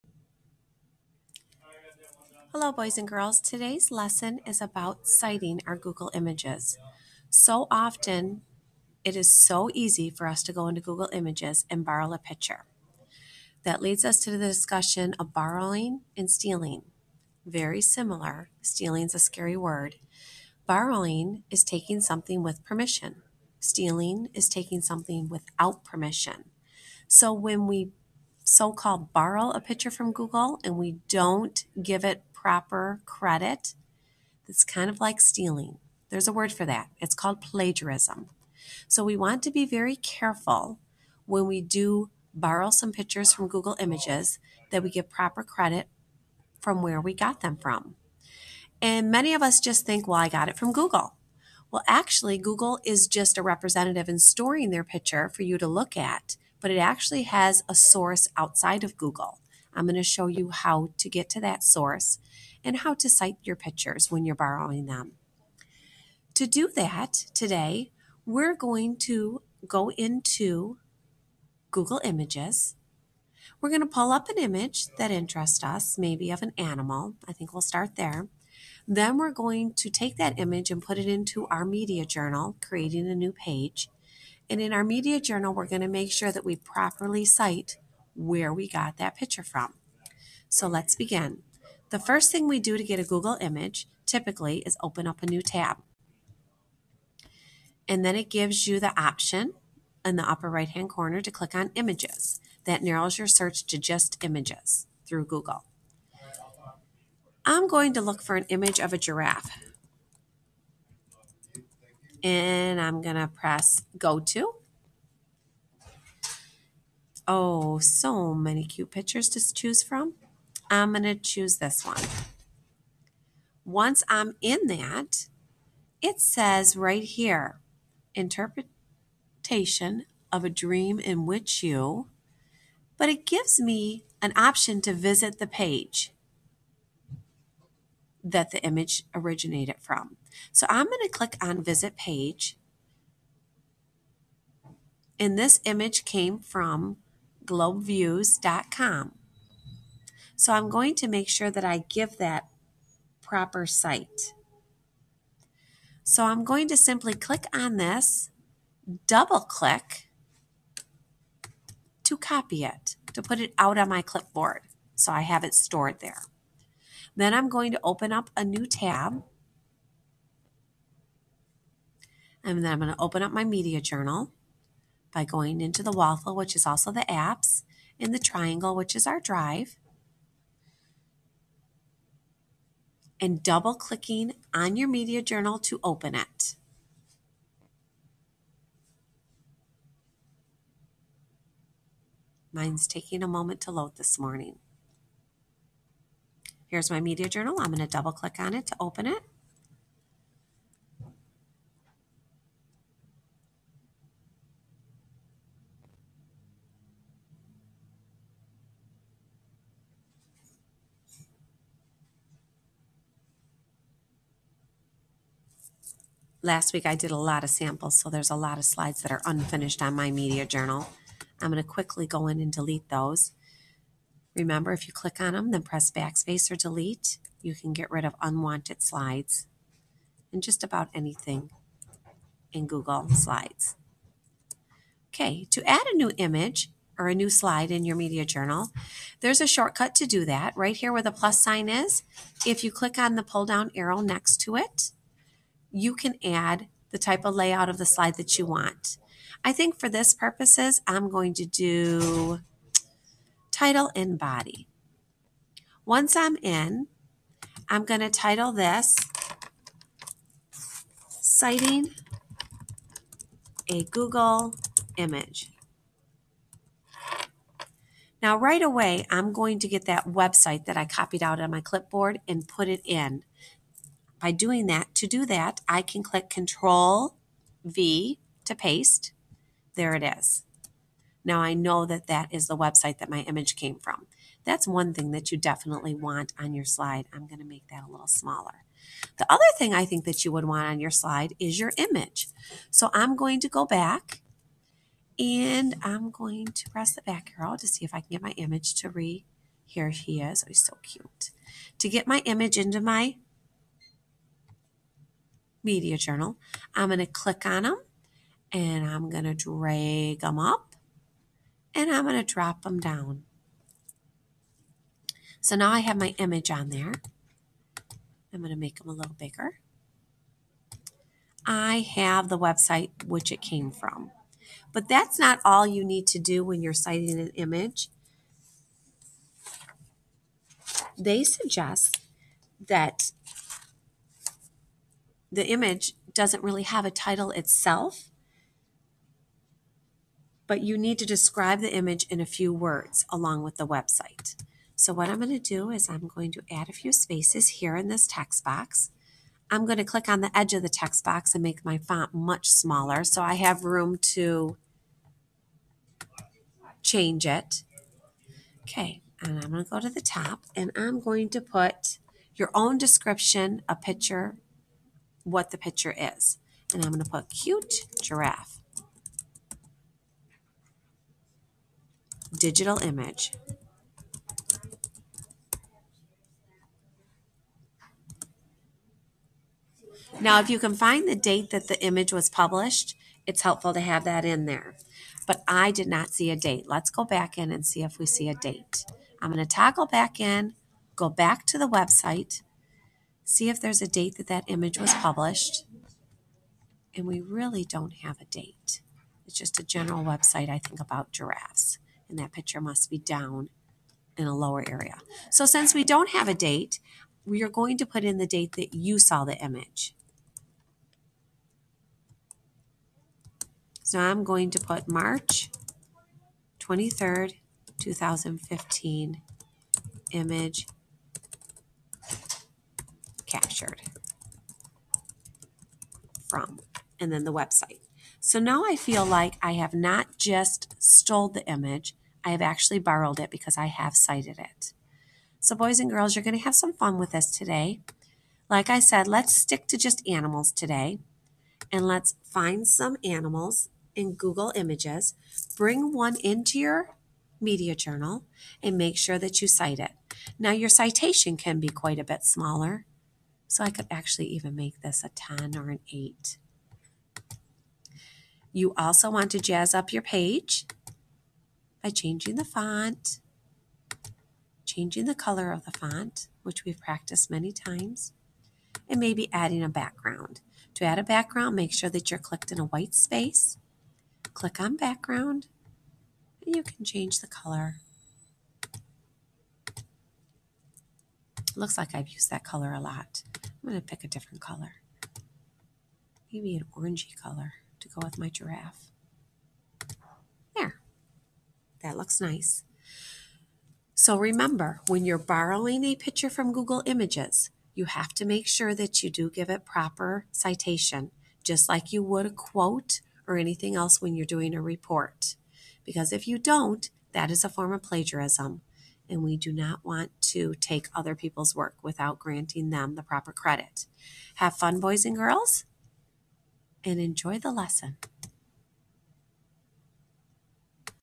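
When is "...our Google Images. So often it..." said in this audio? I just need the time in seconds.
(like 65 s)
5 s.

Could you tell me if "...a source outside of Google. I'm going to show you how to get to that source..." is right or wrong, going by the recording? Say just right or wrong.
right.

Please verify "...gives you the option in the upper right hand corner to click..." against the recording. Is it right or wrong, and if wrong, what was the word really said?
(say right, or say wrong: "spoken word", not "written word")
right.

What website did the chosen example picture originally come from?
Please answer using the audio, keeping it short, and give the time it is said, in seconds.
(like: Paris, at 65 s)
globeviews.com, at 147 s.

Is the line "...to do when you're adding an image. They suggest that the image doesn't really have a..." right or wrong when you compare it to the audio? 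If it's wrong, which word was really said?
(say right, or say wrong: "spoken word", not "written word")
wrong: "citing", not "adding".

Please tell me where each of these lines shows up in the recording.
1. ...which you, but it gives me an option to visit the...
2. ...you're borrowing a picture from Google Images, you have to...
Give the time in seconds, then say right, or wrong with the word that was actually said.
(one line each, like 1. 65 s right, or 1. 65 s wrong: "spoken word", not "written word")
1. 131 s right
2. 495 s right.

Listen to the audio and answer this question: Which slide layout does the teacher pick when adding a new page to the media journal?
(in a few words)
title and body.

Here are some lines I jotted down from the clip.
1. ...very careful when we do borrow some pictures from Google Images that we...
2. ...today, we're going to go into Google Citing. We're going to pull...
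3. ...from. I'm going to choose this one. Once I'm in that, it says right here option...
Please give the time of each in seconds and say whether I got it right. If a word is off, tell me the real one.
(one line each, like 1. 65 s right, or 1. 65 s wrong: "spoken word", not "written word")
1. 39 s right
2. 67 s wrong: "Images", not "Citing"
3. 119 s wrong: "interpretation", not "option".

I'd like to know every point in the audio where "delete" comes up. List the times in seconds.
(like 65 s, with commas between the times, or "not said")
222 s, 226 s.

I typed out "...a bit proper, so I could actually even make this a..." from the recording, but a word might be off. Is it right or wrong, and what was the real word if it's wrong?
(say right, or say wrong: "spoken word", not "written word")
wrong: "smaller", not "proper".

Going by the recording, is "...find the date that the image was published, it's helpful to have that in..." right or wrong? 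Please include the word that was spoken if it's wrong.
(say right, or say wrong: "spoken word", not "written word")
right.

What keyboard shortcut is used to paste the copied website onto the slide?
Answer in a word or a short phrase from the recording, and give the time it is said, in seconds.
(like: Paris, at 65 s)
Control V, at 276 s.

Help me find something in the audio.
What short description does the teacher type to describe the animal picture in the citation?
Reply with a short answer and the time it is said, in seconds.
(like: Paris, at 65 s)
cute giraffe, at 367 s.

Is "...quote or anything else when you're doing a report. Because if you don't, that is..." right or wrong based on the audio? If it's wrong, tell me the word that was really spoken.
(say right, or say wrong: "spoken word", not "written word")
right.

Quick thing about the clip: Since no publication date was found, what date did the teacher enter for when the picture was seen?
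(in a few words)
March 23rd, 2015.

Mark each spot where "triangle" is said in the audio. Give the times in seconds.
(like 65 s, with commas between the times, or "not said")
178 s.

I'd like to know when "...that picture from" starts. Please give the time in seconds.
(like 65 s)
88 s.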